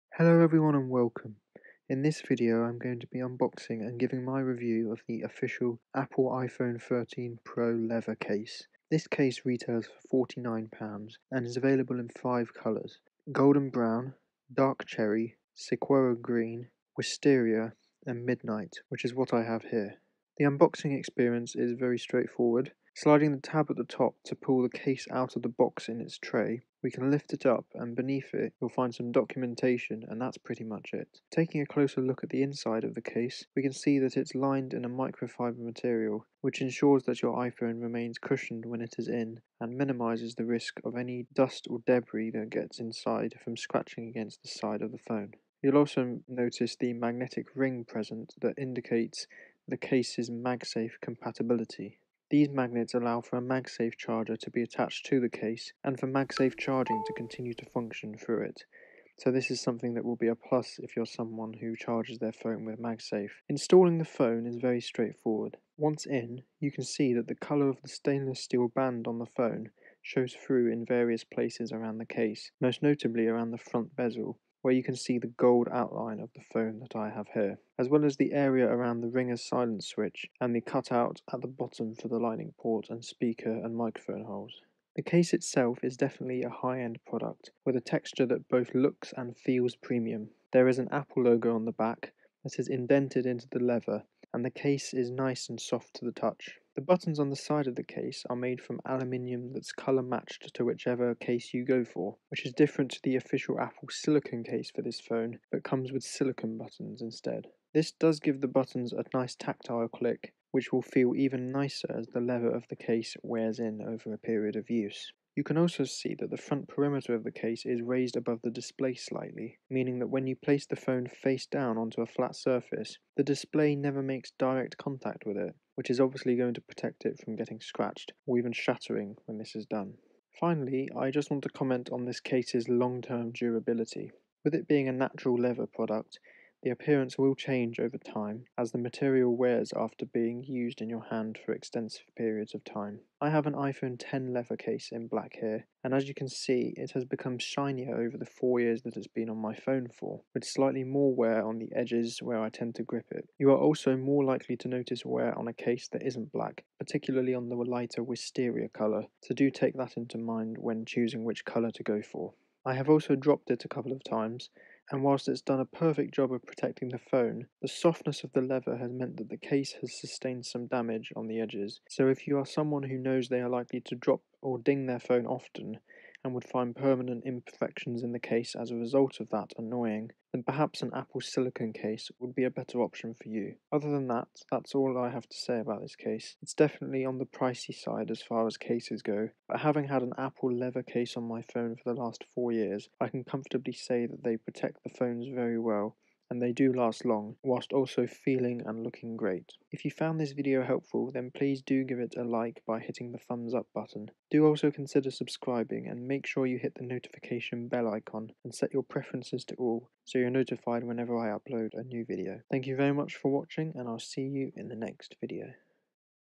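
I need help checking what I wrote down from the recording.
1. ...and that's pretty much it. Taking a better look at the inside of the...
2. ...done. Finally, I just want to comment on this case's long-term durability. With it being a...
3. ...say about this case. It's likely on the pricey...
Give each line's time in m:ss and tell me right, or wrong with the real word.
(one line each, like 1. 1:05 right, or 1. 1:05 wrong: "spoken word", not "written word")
1. 0:30 wrong: "closer", not "better"
2. 2:09 right
3. 3:05 wrong: "definitely", not "likely".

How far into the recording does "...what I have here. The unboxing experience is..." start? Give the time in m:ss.
0:19.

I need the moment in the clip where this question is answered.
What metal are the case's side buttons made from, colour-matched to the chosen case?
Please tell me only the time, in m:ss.
1:38.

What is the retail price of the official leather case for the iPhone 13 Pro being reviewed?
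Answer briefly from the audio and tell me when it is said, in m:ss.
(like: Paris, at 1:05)
£49, at 0:10.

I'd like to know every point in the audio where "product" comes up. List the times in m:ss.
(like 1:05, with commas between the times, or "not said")
1:27, 2:15.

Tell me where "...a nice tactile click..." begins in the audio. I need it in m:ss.
1:48.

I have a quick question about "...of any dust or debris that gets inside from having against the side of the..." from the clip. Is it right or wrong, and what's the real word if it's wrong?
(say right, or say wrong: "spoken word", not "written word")
wrong: "scratching", not "having".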